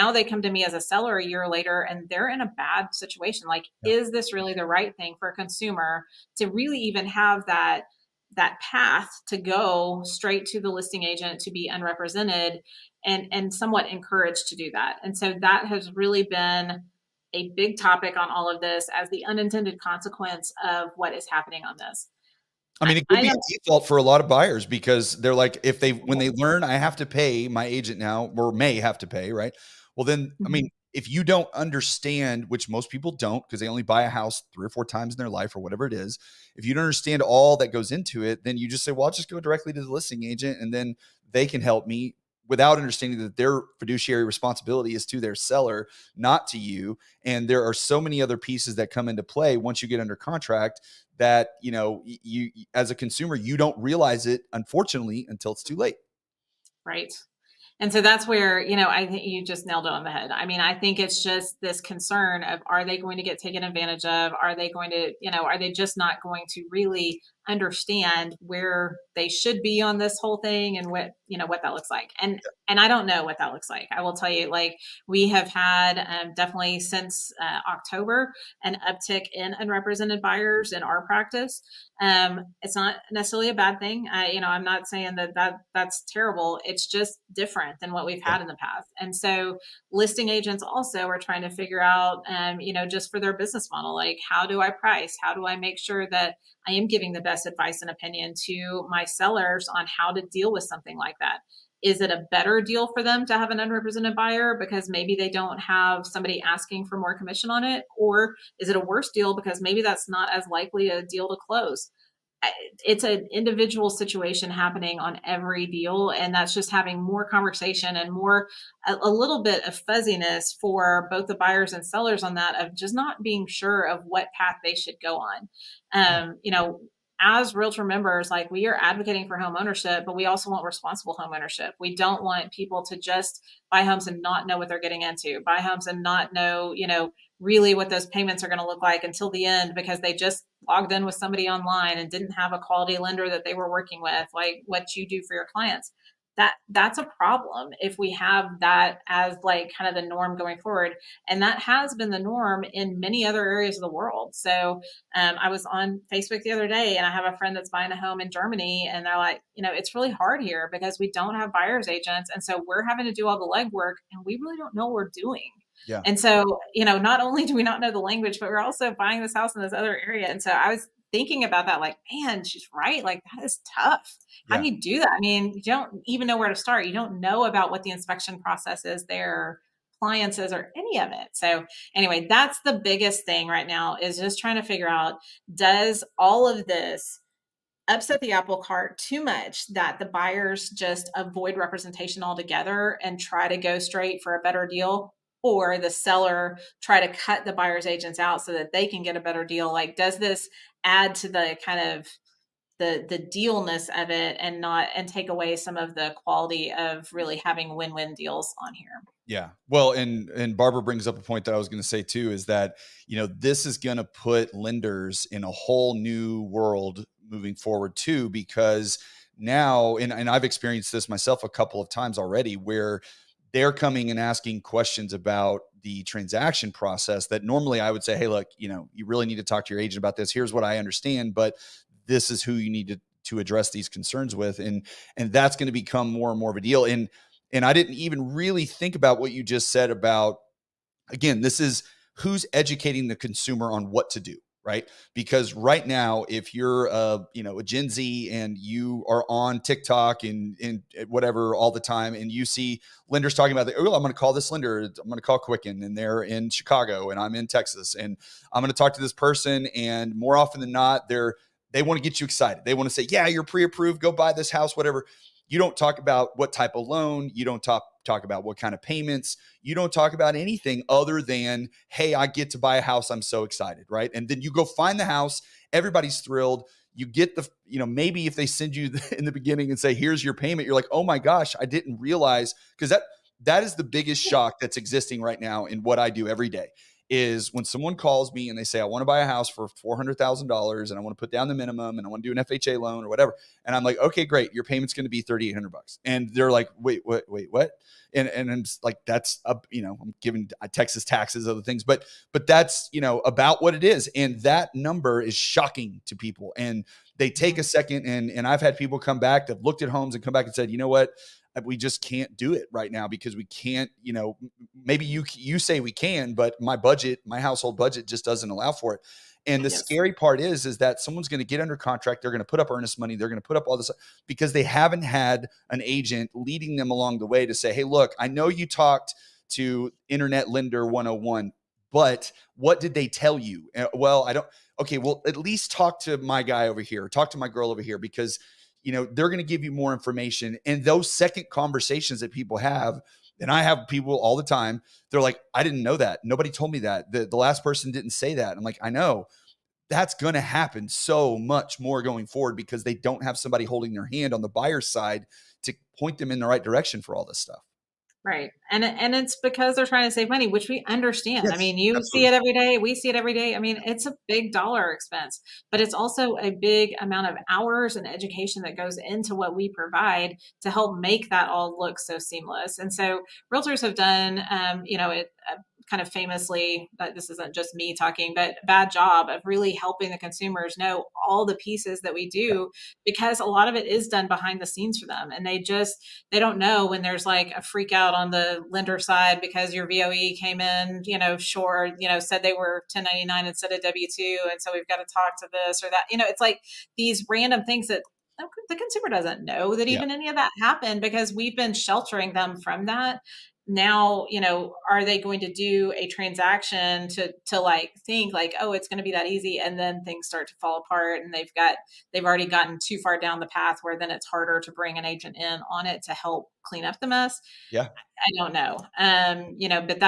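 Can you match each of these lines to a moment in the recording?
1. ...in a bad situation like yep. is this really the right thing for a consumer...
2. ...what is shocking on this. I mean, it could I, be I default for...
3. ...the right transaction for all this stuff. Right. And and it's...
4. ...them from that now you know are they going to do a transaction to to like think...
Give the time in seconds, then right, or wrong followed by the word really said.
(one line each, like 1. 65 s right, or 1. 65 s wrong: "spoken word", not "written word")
1. 2 s right
2. 20 s wrong: "happening", not "shocking"
3. 356 s wrong: "direction", not "transaction"
4. 402 s right.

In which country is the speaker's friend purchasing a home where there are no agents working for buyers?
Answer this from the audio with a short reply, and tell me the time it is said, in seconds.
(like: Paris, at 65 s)
Germany, at 158 s.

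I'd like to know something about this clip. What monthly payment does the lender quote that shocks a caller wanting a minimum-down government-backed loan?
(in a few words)
$3,800.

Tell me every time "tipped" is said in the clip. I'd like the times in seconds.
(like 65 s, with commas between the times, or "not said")
not said.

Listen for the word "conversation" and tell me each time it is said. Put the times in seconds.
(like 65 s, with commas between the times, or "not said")
117 s, 341 s.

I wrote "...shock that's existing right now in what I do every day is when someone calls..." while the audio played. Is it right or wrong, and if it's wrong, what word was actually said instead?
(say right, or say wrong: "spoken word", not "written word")
right.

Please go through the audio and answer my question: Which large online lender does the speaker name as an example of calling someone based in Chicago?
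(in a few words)
Quicken.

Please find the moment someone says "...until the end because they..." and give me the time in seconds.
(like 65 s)
139 s.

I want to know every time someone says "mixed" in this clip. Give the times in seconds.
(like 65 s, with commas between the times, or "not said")
not said.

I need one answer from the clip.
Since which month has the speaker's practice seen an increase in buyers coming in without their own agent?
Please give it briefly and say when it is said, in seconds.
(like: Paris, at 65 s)
October, at 77 s.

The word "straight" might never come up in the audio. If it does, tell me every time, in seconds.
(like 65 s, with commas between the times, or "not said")
10 s, 193 s.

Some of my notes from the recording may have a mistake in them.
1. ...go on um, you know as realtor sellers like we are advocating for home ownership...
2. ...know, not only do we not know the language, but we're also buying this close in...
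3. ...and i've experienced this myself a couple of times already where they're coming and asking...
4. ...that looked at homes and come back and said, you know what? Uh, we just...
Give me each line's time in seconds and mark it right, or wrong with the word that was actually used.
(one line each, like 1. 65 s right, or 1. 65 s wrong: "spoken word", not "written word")
1. 125 s wrong: "members", not "sellers"
2. 166 s wrong: "house", not "close"
3. 220 s right
4. 309 s right.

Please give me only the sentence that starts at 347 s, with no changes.
The, the last person didn't say that.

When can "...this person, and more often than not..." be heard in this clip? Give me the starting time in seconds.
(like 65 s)
259 s.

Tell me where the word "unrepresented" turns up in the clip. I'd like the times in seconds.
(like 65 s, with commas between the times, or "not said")
11 s, 79 s, 103 s.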